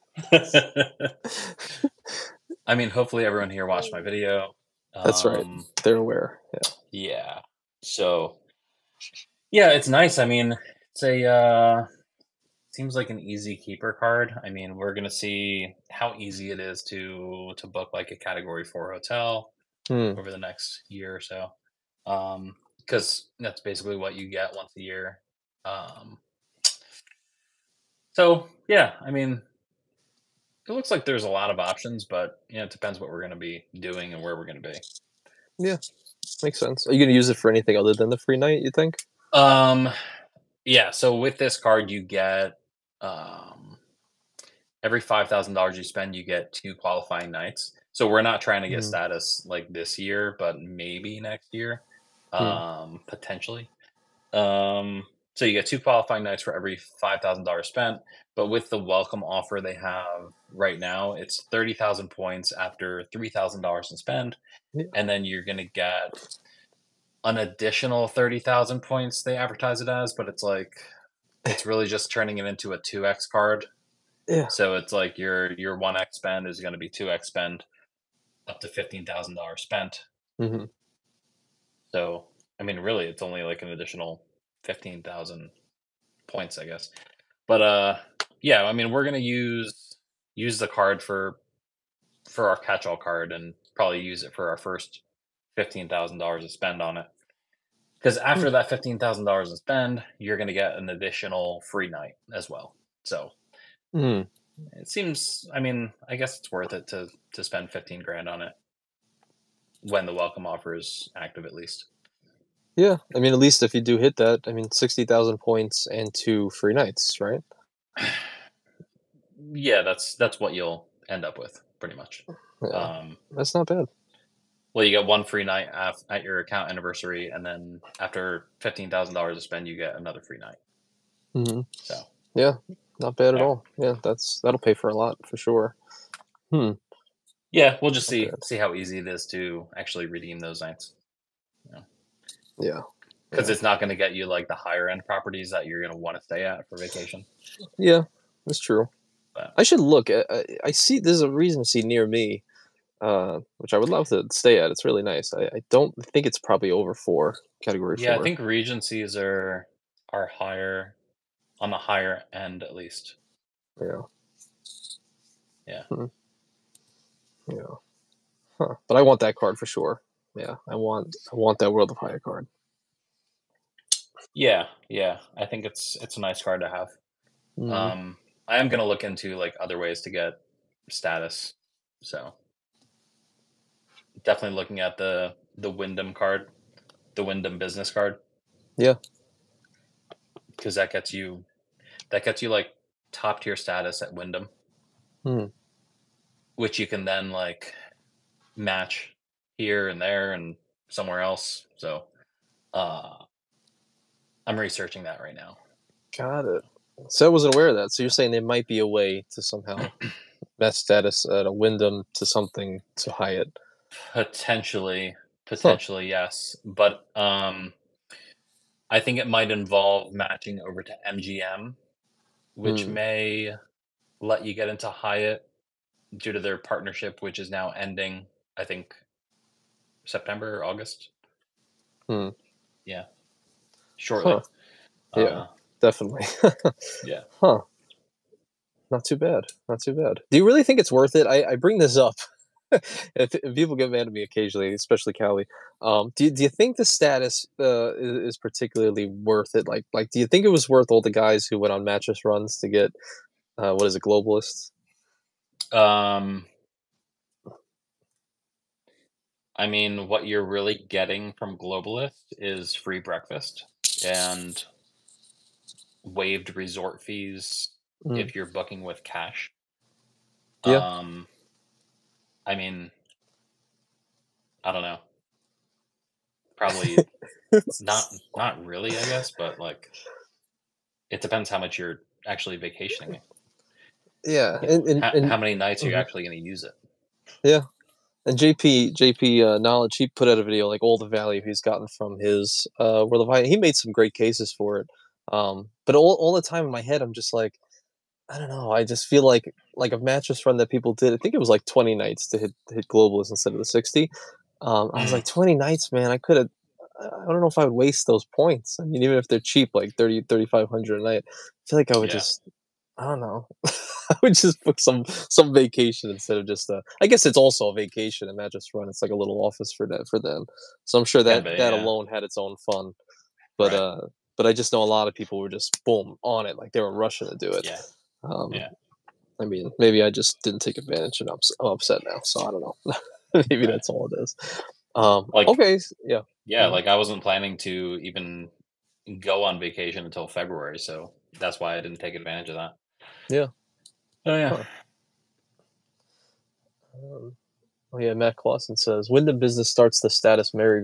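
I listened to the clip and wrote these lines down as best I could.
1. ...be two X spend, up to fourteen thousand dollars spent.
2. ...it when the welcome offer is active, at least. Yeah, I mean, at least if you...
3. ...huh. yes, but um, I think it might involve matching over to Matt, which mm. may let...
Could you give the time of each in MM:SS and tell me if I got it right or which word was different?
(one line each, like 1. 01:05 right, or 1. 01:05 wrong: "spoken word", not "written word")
1. 01:16 wrong: "fifteen", not "fourteen"
2. 01:48 right
3. 03:36 wrong: "MGM", not "Matt".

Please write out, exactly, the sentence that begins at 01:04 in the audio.
and then you're gonna get an additional thirty thousand points.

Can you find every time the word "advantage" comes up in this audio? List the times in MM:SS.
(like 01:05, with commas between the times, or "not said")
05:30, 05:42.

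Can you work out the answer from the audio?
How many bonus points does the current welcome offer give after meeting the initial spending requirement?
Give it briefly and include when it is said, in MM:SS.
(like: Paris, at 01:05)
30,000, at 01:01.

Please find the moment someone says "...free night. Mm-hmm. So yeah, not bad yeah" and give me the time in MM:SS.
02:10.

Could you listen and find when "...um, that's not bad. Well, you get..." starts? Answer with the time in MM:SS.
02:02.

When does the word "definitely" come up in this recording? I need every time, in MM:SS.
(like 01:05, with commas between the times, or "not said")
03:04, 03:55.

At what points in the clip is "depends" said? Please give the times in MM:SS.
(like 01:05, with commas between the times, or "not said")
00:32, 04:41.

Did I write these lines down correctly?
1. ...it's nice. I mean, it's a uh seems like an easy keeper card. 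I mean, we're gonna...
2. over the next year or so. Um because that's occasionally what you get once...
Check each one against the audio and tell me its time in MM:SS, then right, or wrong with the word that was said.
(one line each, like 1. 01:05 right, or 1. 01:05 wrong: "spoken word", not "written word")
1. 00:09 right
2. 00:20 wrong: "basically", not "occasionally".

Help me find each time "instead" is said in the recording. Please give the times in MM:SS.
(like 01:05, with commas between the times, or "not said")
05:03, 05:16.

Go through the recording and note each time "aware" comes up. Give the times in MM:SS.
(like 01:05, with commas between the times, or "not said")
00:05, 03:27.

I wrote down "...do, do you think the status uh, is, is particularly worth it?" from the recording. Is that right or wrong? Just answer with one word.
right.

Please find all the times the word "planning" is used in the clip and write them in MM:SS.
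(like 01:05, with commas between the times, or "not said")
05:37.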